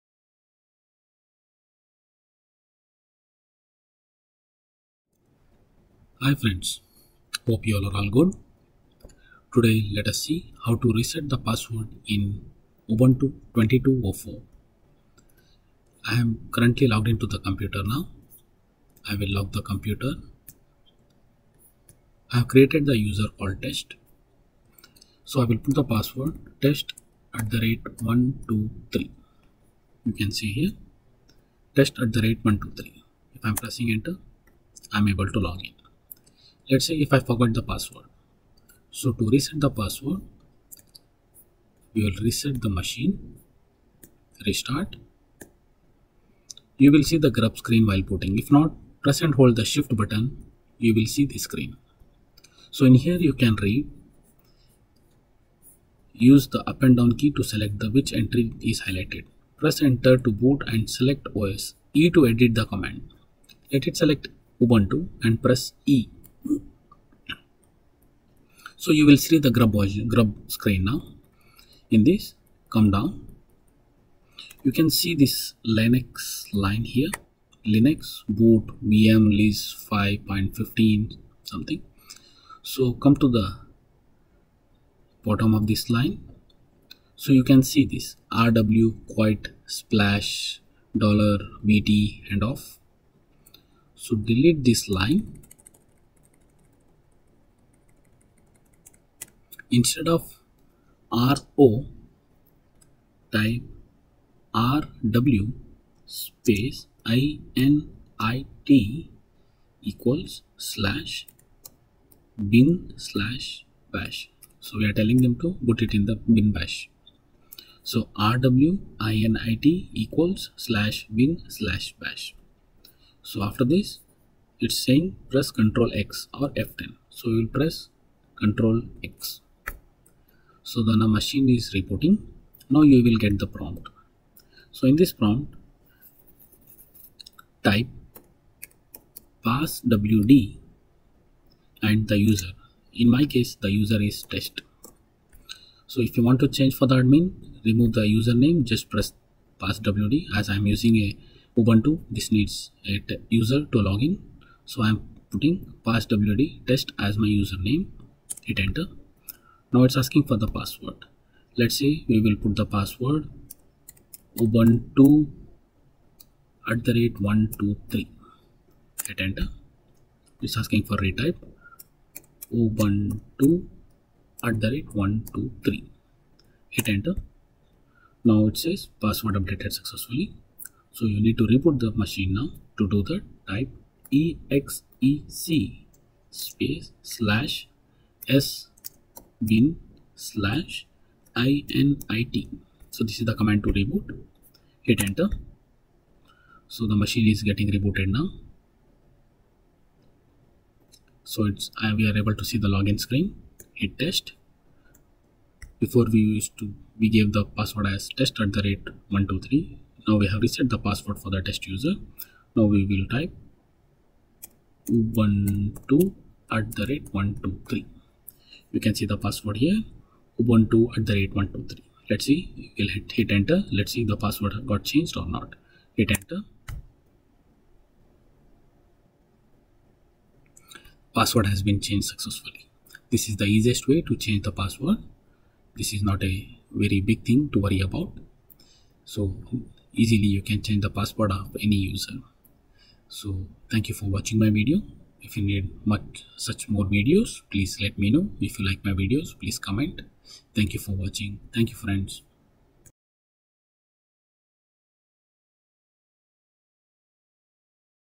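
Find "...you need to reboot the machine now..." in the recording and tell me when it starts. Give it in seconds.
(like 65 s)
181 s.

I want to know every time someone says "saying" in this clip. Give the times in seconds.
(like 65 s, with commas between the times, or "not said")
124 s.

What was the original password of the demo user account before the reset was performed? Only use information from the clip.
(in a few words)
test@123.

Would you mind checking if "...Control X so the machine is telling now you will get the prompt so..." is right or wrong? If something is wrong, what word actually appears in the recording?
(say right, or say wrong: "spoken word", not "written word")
wrong: "reporting", not "telling".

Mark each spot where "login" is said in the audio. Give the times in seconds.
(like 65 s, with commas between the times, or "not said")
153 s, 202 s.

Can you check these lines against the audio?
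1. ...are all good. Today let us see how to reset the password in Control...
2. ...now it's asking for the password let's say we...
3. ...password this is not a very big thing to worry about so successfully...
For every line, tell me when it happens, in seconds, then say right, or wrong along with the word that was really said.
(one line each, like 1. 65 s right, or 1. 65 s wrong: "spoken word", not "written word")
1. 7 s wrong: "Ubuntu", not "Control"
2. 159 s right
3. 234 s wrong: "easily", not "successfully".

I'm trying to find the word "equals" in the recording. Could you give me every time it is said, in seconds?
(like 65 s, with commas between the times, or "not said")
109 s, 119 s.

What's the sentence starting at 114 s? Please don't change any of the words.
So we are telling them to put it in the bin bash.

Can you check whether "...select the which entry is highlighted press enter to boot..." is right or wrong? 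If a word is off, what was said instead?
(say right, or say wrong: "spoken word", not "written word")
right.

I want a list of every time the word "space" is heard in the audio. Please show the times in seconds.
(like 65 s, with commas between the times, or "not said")
106 s, 186 s.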